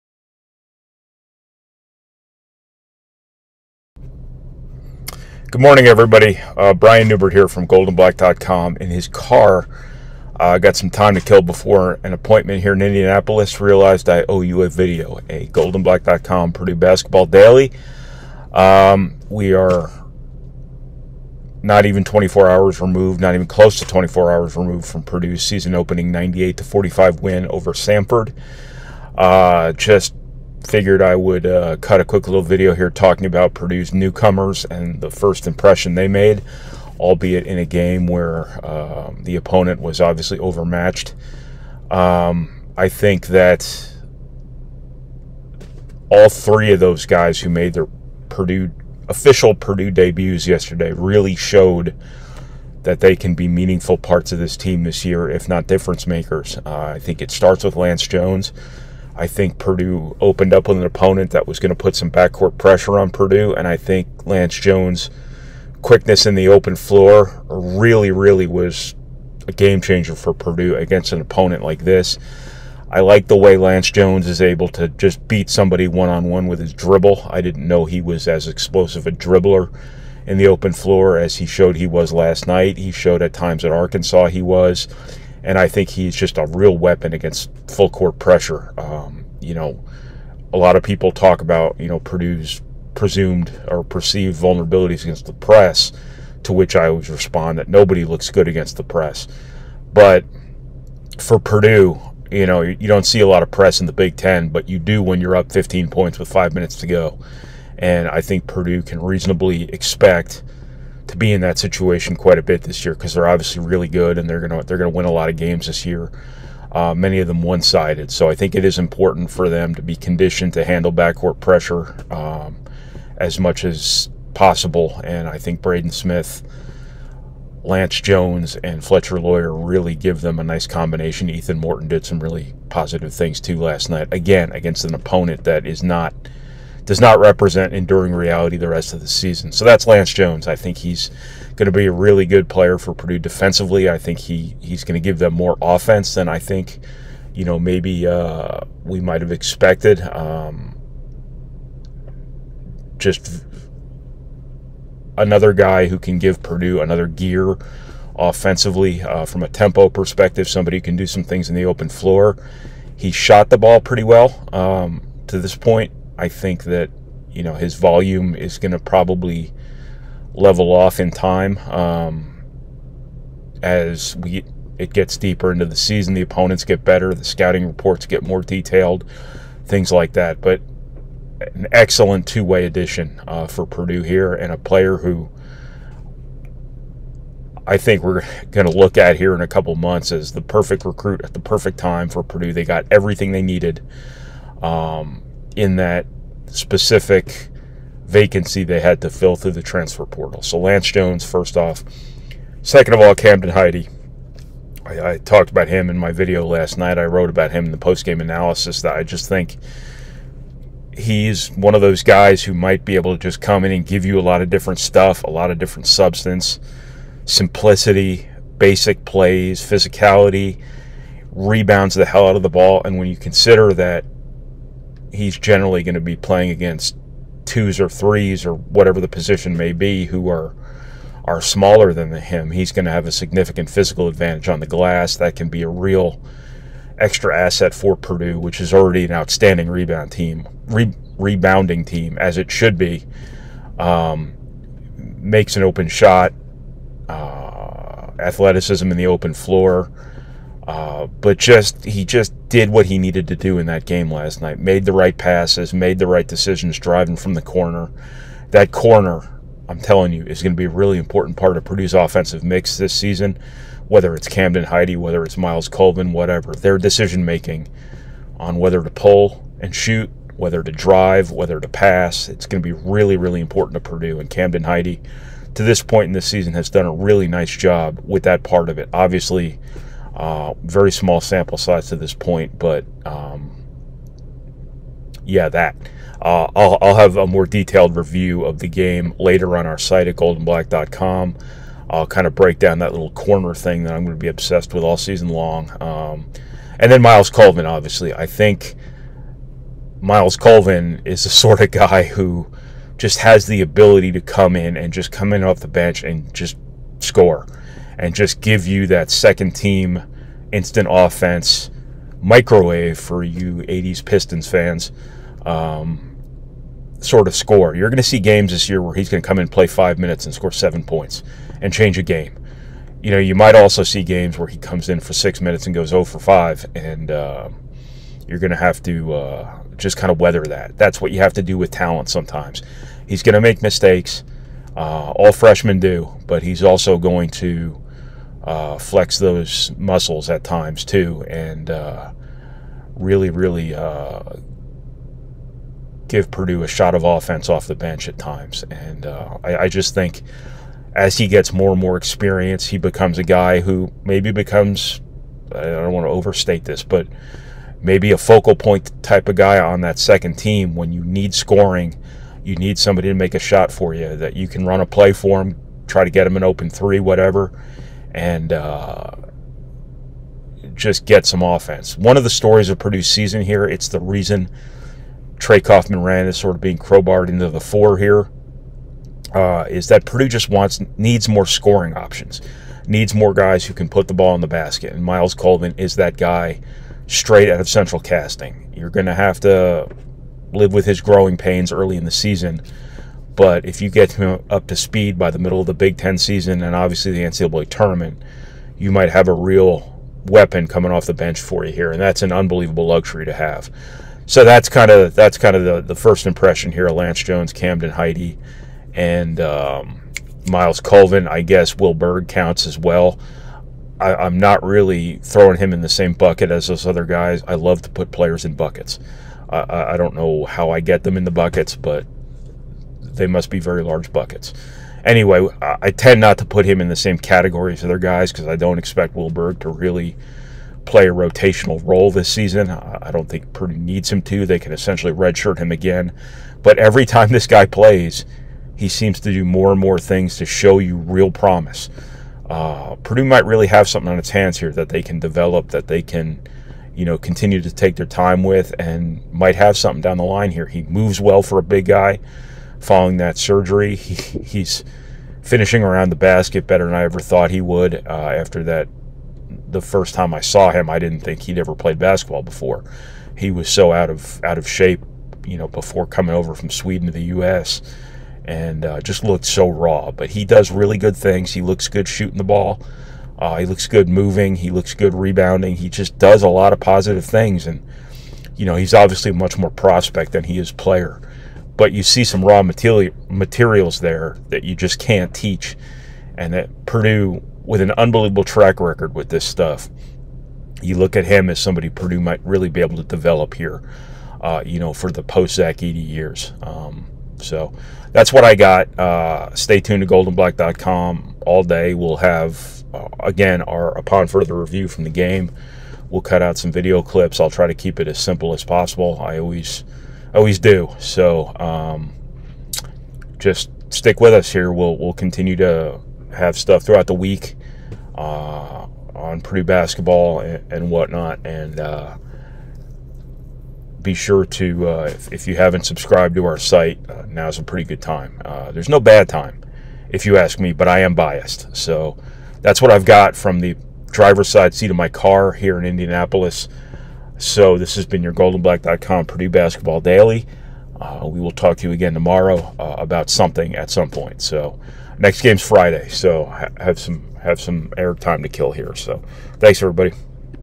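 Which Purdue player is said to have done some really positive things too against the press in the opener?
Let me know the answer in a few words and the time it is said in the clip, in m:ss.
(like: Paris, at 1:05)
Ethan Morton, at 2:11.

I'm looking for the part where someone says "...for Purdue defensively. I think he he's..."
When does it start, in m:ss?
2:22.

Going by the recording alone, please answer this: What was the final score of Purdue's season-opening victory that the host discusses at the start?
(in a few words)
98 to 45.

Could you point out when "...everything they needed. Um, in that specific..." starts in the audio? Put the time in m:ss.
3:12.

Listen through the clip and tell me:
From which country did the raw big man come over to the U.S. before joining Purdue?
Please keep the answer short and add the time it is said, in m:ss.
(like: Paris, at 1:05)
Sweden, at 7:46.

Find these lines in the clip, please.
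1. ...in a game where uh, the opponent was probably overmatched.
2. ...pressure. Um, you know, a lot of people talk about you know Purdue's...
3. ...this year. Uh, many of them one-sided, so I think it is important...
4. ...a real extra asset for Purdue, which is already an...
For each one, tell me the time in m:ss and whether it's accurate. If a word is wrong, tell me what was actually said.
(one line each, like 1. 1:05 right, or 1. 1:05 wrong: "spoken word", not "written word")
1. 0:37 wrong: "obviously", not "probably"
2. 1:28 right
3. 1:55 right
4. 3:55 right.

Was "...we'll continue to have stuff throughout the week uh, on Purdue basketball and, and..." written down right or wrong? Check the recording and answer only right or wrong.
right.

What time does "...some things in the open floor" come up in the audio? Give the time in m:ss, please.
2:41.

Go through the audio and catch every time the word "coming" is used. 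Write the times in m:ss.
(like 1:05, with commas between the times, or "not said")
6:40, 7:46.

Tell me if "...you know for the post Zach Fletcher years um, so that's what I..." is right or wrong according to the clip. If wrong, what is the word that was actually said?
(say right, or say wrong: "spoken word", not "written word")
wrong: "Edey", not "Fletcher".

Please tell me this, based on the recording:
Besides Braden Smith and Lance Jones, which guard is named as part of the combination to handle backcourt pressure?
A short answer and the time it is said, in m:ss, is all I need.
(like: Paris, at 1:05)
Fletcher Loyer, at 2:08.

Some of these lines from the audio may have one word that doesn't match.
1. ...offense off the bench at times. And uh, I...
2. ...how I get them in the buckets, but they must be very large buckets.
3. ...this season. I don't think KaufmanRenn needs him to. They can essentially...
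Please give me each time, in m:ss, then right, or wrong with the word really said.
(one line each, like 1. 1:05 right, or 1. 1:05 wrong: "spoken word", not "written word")
1. 5:47 right
2. 7:00 right
3. 7:12 wrong: "Purdue", not "KaufmanRenn".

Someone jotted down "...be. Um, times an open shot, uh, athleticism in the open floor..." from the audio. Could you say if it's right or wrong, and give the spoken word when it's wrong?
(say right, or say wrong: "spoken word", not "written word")
wrong: "makes", not "times".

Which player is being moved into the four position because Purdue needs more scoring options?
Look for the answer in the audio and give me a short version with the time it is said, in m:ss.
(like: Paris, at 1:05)
Trey Kaufman-Renn, at 6:15.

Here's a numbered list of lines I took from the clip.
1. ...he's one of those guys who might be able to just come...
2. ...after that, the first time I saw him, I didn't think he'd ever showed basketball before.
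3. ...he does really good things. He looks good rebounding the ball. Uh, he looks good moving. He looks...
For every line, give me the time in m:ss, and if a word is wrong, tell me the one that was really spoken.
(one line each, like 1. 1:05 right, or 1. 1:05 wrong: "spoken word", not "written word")
1. 3:30 right
2. 7:38 wrong: "played", not "showed"
3. 7:50 wrong: "shooting", not "rebounding".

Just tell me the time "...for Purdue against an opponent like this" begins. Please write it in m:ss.
1:10.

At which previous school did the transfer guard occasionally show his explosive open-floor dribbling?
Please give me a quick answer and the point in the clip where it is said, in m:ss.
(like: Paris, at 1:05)
Arkansas, at 1:23.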